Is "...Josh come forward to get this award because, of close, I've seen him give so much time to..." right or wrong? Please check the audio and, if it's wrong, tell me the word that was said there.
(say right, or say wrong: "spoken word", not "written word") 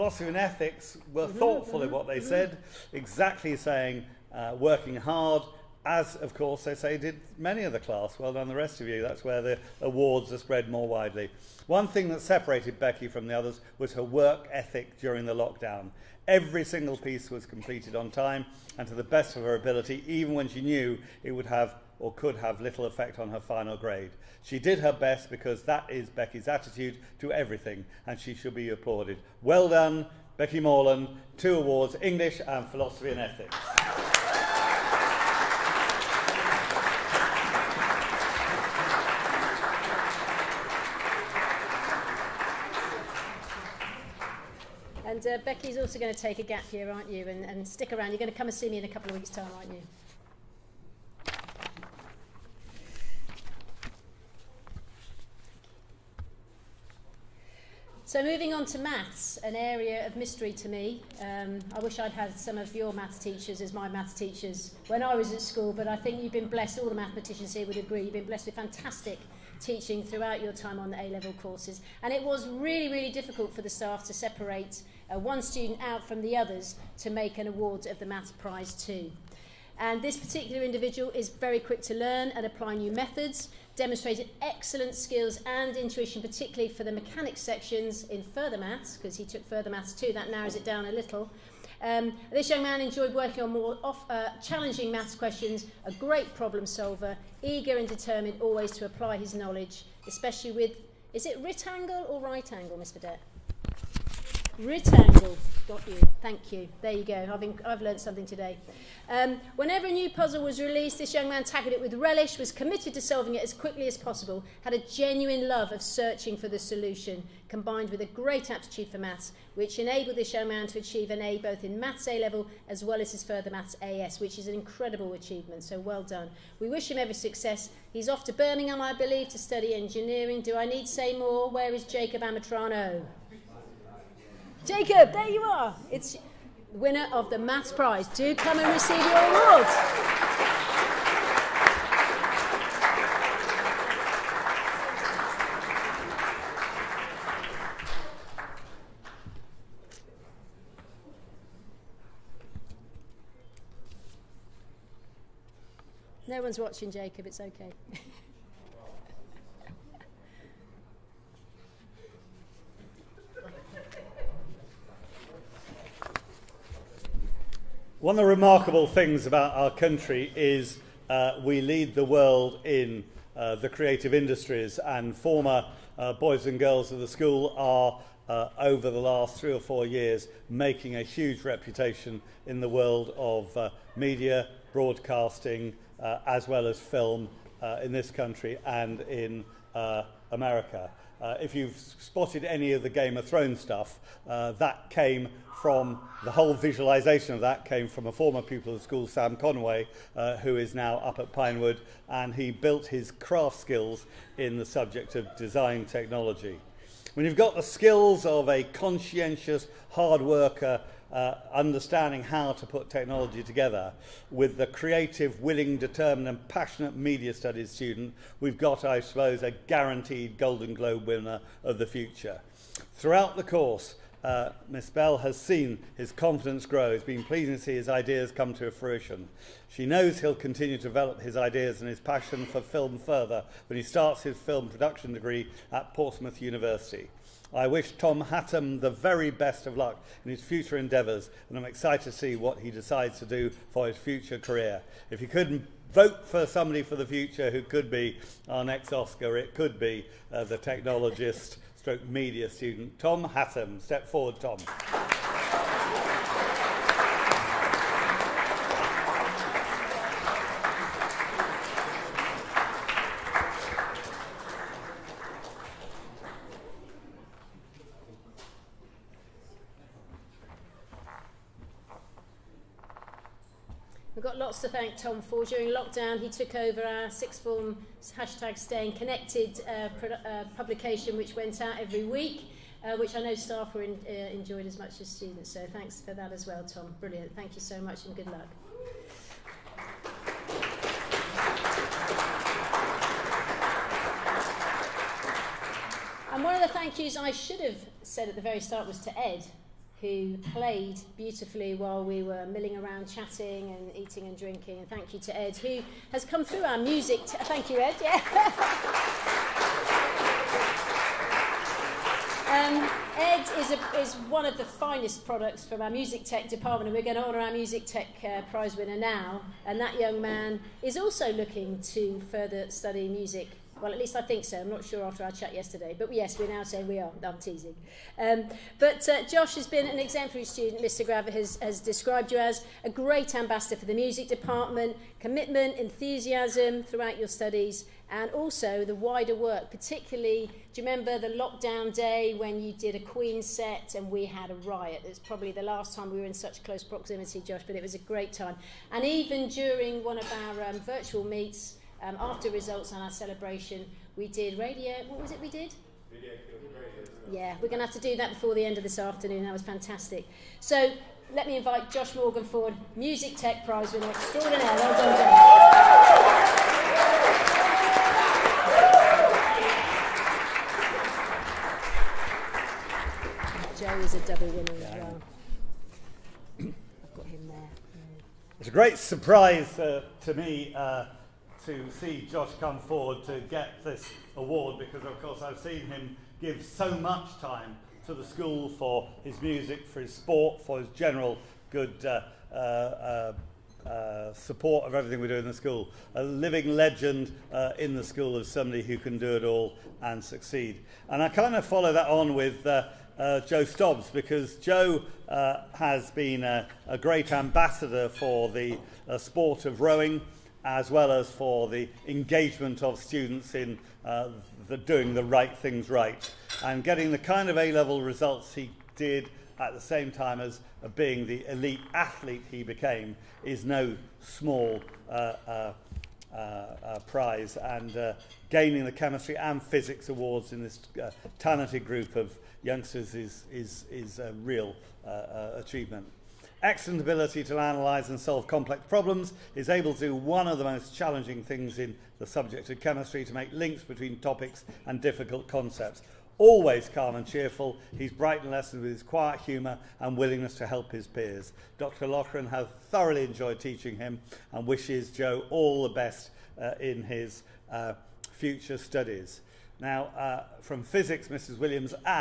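wrong: "course", not "close".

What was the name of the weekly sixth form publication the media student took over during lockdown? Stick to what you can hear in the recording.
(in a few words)
Staying Connected.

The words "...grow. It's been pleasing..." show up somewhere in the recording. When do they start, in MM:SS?
03:46.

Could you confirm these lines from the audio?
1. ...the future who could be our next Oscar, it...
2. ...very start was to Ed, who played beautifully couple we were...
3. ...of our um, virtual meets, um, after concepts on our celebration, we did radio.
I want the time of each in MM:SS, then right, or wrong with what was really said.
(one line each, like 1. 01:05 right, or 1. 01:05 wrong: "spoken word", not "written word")
1. 04:06 right
2. 04:58 wrong: "while", not "couple"
3. 05:50 wrong: "results", not "concepts".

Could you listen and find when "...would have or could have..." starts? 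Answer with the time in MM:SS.
00:21.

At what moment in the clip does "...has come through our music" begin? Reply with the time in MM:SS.
05:06.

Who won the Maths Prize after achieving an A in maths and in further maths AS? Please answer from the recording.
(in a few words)
Jacob Amatrano.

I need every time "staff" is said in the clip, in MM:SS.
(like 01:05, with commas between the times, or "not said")
01:13, 04:43.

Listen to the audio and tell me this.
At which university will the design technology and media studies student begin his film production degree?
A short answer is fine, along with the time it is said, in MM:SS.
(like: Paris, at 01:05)
Portsmouth University, at 03:55.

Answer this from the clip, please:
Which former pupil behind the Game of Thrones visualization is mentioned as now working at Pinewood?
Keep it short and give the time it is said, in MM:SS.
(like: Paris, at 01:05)
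Sam Conway, at 03:19.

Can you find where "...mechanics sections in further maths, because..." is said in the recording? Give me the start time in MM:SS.
01:26.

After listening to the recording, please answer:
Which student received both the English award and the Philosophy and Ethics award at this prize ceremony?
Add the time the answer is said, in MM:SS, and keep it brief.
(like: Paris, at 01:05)
Becky Morland, at 00:30.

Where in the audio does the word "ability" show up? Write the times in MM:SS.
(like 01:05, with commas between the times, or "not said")
00:19, 07:16.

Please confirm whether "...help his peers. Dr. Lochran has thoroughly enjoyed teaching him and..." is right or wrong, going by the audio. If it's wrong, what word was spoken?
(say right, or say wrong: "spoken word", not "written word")
right.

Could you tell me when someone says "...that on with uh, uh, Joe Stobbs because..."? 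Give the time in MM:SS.
06:41.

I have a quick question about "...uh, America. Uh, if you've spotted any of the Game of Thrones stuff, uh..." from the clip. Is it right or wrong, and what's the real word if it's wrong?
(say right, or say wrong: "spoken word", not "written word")
right.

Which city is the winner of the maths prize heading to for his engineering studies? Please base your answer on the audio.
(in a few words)
Birmingham.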